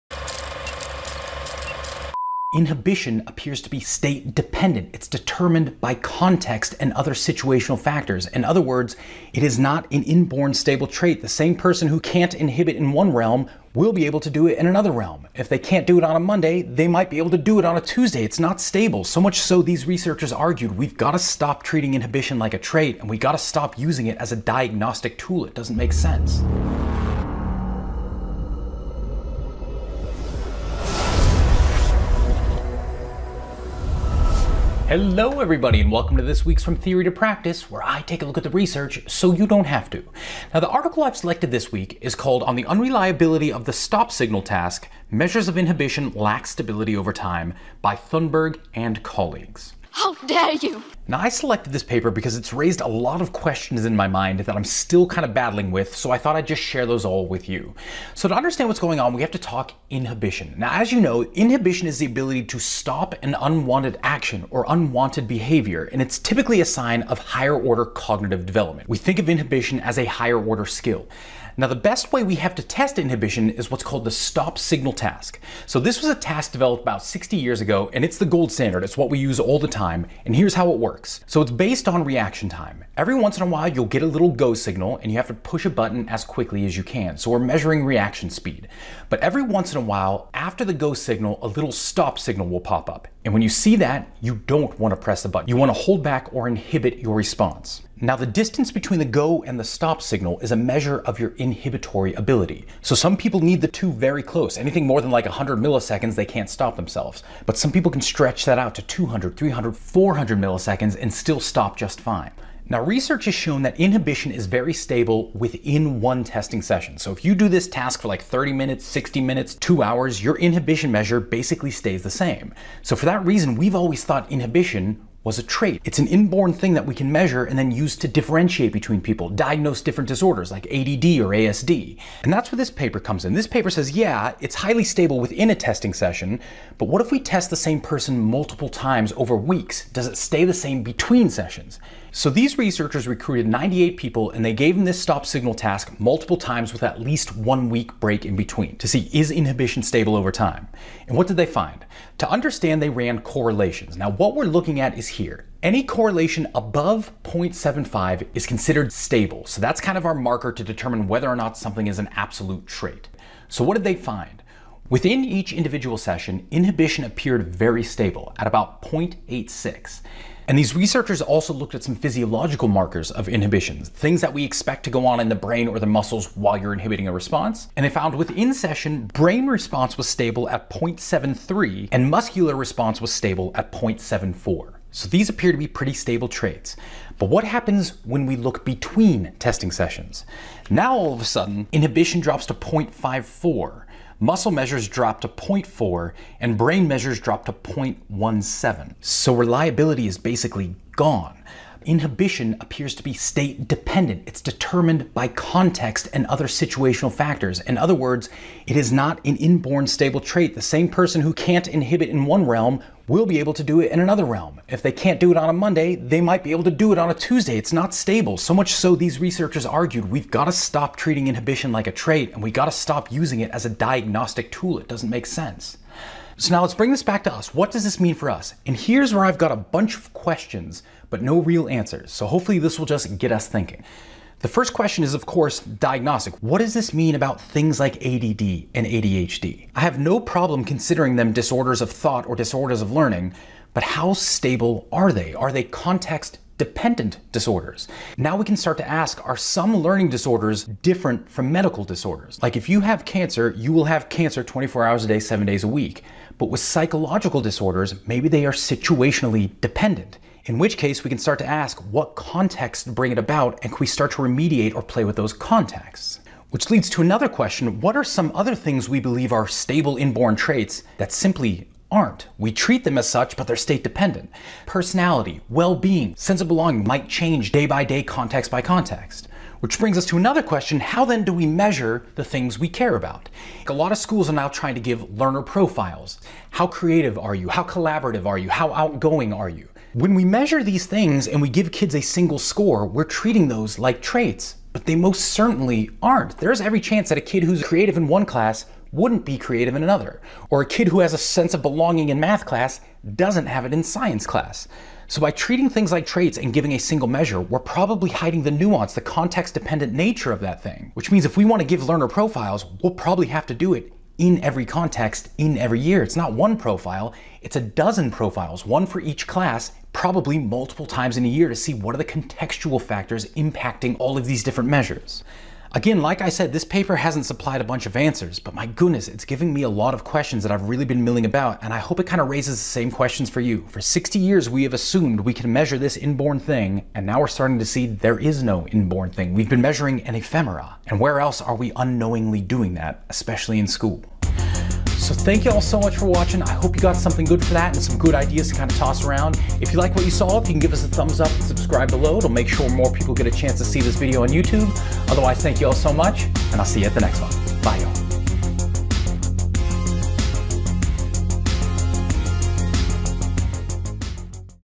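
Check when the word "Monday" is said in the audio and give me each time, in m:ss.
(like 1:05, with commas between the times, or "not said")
0:16, 3:35.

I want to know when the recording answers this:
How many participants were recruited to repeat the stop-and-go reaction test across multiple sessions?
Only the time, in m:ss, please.
2:23.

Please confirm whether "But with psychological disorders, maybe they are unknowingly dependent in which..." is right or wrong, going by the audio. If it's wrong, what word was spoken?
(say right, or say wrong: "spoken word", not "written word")
wrong: "situationally", not "unknowingly".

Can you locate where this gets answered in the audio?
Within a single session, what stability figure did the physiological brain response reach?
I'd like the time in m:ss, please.
3:00.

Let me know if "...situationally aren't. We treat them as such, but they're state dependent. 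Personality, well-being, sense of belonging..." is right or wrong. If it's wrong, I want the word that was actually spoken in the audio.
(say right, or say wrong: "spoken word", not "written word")
wrong: "simply", not "situationally".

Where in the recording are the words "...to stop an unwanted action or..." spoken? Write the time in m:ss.
1:02.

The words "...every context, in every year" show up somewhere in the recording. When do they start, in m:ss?
5:14.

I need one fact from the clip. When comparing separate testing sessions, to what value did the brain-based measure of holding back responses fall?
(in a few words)
0.17.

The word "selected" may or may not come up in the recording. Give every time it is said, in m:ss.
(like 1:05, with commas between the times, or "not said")
0:41, 0:51.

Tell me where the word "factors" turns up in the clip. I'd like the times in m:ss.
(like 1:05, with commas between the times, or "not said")
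0:07, 3:27, 5:22.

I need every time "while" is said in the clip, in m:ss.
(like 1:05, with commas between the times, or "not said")
1:23, 1:29, 2:56.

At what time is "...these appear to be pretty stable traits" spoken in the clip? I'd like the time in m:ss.
3:05.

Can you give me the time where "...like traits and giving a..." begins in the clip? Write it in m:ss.
5:05.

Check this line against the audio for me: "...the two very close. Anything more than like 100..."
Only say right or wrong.
right.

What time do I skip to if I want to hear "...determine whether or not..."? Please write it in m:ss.
2:40.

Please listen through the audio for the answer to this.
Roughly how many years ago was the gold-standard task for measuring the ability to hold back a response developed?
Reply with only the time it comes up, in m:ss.
1:16.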